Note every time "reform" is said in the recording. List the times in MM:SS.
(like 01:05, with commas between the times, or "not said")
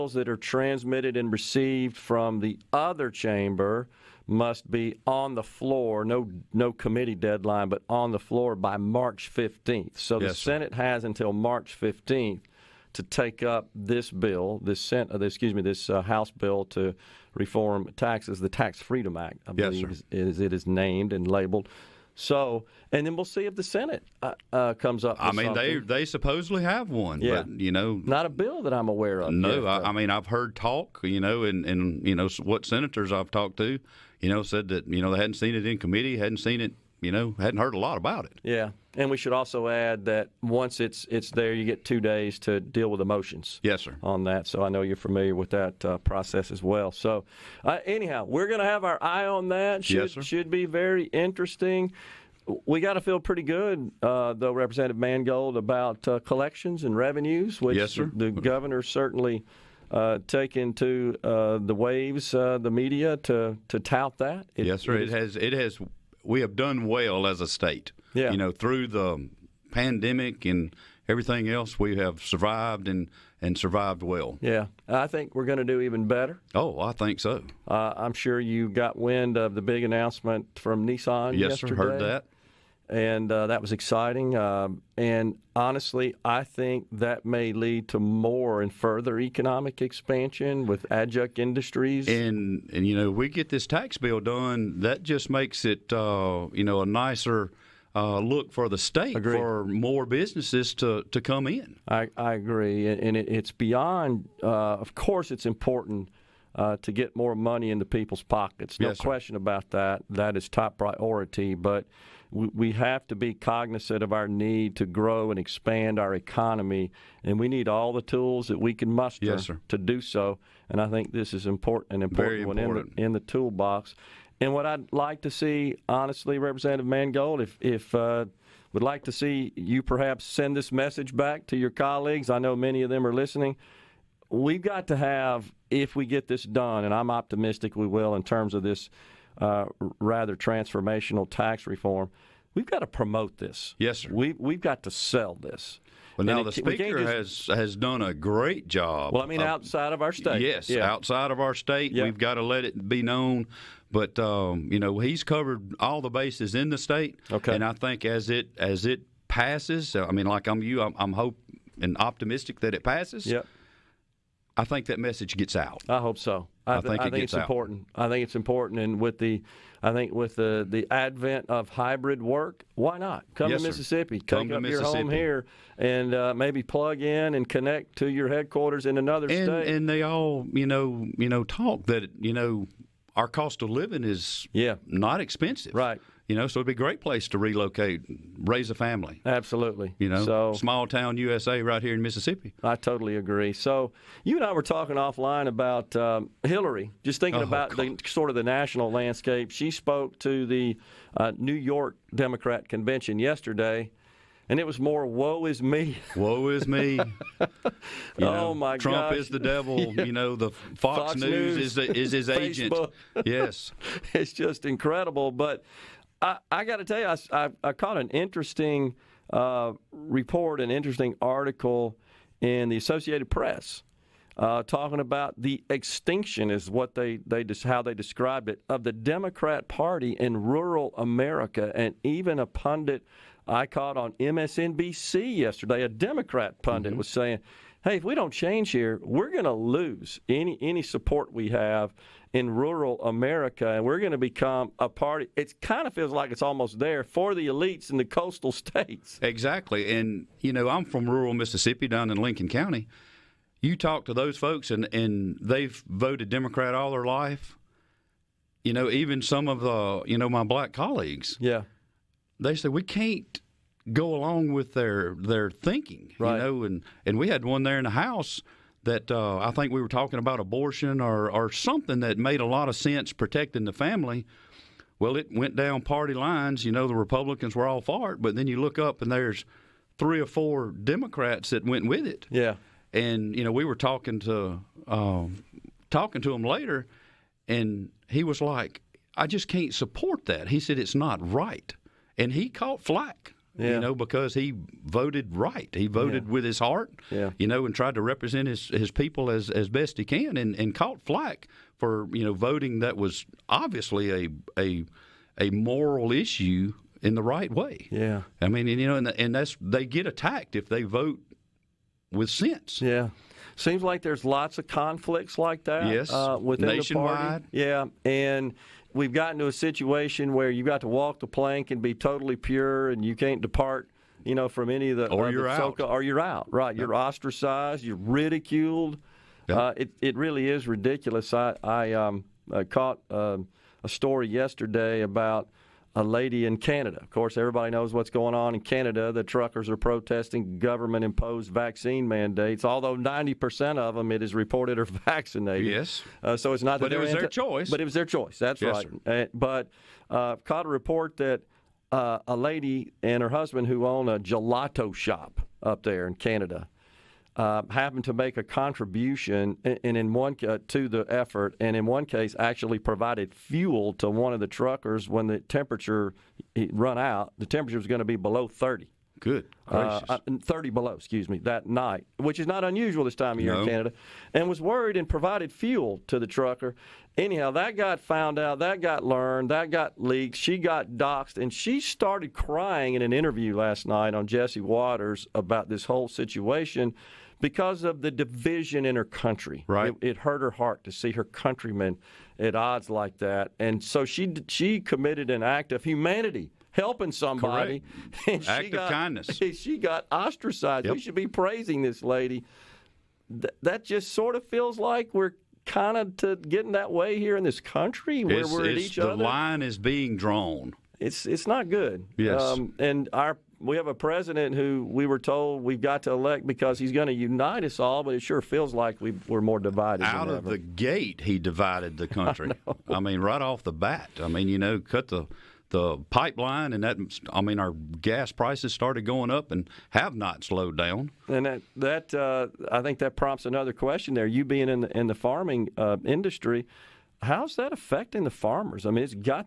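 00:17, 02:21.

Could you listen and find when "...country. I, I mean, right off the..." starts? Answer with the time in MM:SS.
07:02.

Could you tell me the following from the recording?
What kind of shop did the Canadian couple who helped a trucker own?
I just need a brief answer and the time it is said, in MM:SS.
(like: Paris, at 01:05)
Gelato shop, at 05:54.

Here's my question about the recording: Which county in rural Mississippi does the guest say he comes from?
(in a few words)
Lincoln County.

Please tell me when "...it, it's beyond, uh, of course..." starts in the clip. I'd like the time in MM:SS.
01:43.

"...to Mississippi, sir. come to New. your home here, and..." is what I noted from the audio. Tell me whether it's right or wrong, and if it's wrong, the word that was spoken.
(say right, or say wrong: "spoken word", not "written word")
wrong: "Mississippi", not "New".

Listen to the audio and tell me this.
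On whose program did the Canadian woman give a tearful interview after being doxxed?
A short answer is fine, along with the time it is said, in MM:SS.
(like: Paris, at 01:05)
Jesse Watters, at 06:24.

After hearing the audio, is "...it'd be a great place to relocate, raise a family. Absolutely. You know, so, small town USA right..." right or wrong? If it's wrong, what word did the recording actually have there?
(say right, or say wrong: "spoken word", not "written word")
right.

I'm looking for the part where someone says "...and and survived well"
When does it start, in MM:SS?
01:12.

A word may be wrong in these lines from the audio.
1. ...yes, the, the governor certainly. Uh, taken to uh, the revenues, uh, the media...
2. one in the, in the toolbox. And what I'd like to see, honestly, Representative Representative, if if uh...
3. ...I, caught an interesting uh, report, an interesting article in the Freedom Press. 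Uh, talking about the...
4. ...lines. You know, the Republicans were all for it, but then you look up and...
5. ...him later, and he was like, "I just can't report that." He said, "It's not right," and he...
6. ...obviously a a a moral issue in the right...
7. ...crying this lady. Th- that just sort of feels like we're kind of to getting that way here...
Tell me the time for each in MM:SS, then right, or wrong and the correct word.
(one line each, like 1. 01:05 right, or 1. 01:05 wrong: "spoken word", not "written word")
1. 00:57 wrong: "waves", not "revenues"
2. 02:02 wrong: "Mangold", not "Representative"
3. 03:37 wrong: "Associated", not "Freedom"
4. 04:36 right
5. 04:46 wrong: "support", not "report"
6. 05:03 right
7. 06:41 wrong: "praising", not "crying".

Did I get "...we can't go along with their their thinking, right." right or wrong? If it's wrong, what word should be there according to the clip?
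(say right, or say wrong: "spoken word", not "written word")
right.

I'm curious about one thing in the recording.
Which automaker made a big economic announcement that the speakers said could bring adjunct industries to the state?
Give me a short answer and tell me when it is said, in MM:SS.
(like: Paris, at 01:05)
Nissan, at 01:20.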